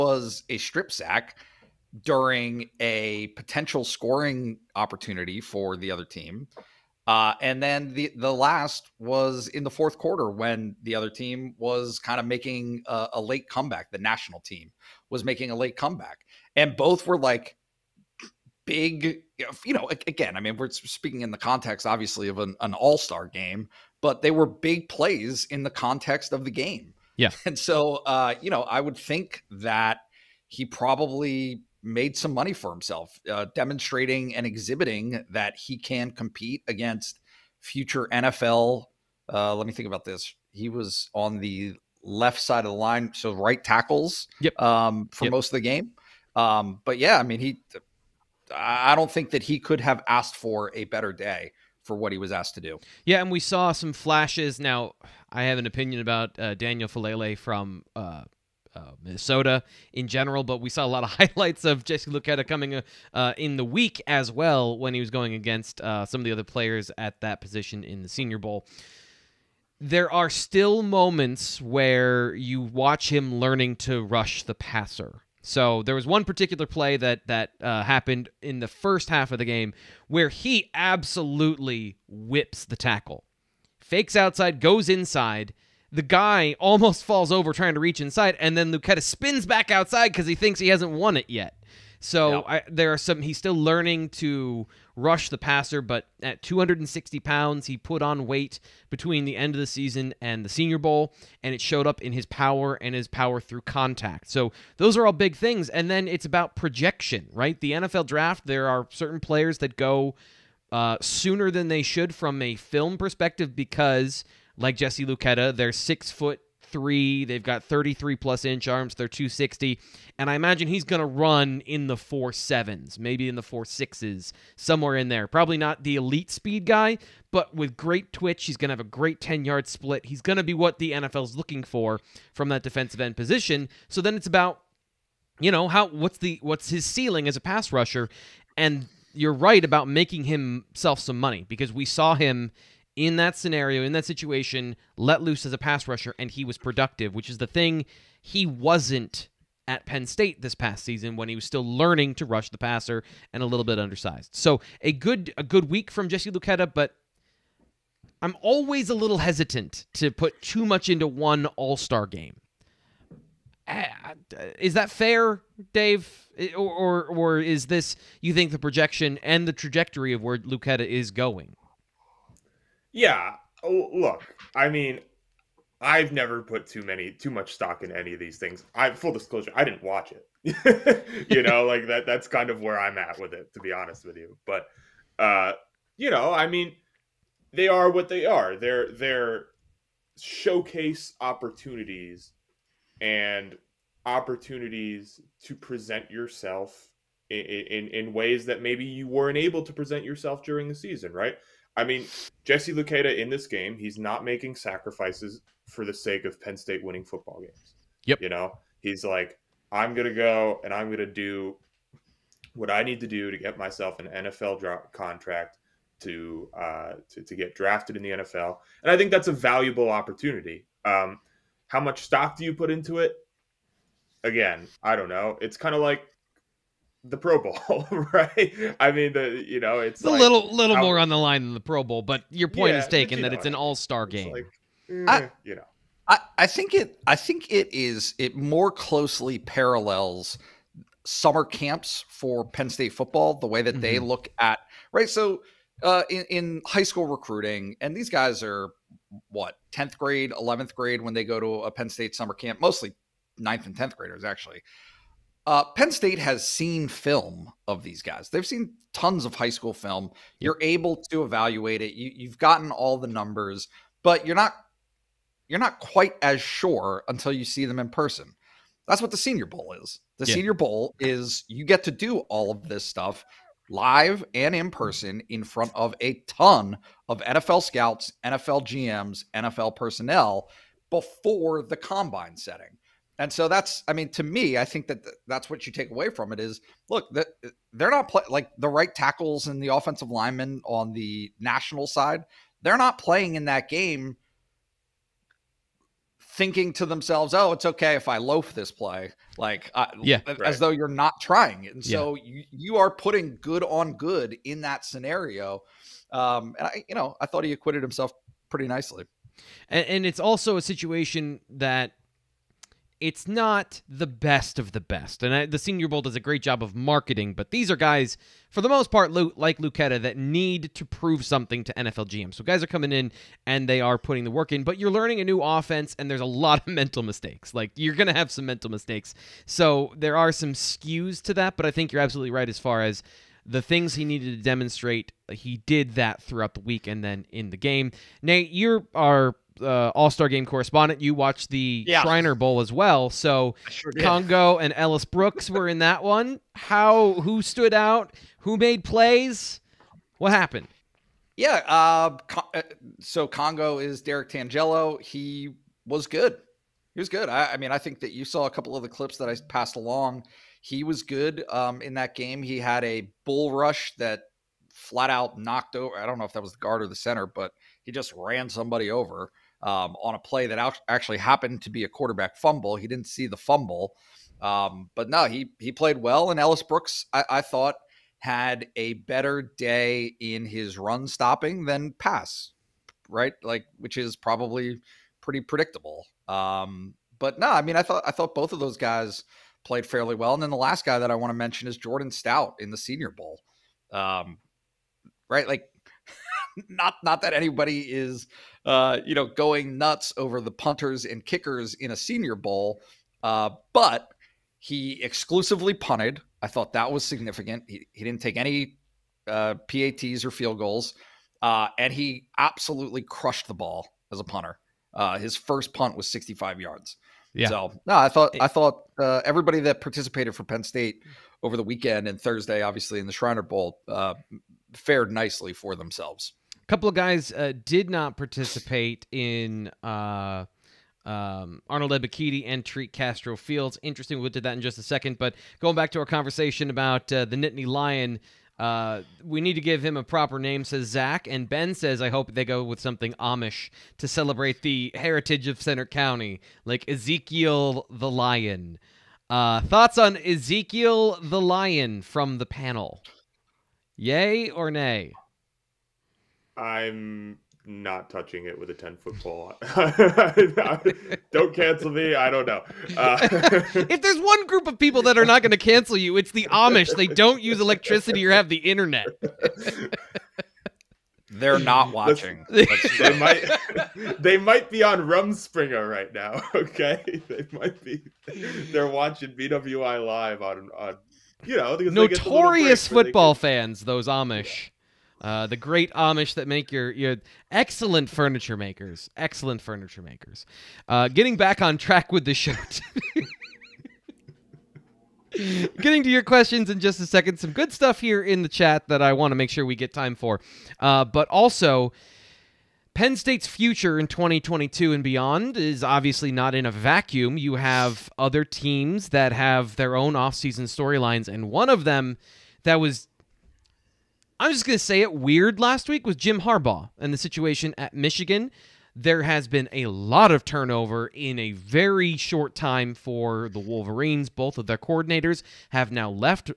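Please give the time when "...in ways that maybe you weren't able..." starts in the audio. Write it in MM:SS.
03:17.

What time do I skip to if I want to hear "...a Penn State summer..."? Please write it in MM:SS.
04:11.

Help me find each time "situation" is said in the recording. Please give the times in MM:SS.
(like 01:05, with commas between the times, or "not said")
02:24, 05:10, 08:37.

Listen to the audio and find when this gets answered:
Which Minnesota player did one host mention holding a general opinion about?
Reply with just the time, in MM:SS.
00:56.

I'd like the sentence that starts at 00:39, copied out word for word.
Uh, let me think about this.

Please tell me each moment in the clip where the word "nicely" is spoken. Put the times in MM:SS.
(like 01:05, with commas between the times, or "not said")
05:08, 07:05.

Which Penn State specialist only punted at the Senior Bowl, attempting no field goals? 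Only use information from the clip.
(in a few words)
Jordan Stout.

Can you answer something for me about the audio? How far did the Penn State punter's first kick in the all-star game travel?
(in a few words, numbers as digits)
65 yards.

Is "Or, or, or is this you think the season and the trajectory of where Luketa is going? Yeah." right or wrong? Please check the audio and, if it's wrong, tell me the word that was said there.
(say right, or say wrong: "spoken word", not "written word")
wrong: "projection", not "season".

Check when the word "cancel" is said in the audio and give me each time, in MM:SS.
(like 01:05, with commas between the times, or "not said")
07:41, 07:45.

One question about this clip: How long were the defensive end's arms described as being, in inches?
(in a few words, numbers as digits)
33 plus.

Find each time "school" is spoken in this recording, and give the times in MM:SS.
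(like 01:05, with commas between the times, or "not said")
04:06, 04:19.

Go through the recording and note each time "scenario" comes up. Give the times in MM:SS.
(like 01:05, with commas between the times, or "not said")
02:23, 05:04.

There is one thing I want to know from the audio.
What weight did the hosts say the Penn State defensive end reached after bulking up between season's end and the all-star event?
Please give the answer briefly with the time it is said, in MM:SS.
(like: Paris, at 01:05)
260 pounds, at 01:36.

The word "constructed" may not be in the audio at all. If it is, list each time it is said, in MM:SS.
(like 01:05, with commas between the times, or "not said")
not said.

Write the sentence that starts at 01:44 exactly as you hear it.
So those are all big things.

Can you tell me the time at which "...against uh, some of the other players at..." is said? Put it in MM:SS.
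01:05.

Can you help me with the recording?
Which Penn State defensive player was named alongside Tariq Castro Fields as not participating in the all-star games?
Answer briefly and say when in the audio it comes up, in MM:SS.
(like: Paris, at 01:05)
Arnold Ebiketie, at 07:11.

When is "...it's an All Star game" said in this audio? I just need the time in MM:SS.
03:53.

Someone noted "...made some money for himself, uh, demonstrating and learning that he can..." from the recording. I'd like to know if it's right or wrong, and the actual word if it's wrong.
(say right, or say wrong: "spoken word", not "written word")
wrong: "exhibiting", not "learning".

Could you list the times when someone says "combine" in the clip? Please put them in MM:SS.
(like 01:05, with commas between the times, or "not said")
04:41.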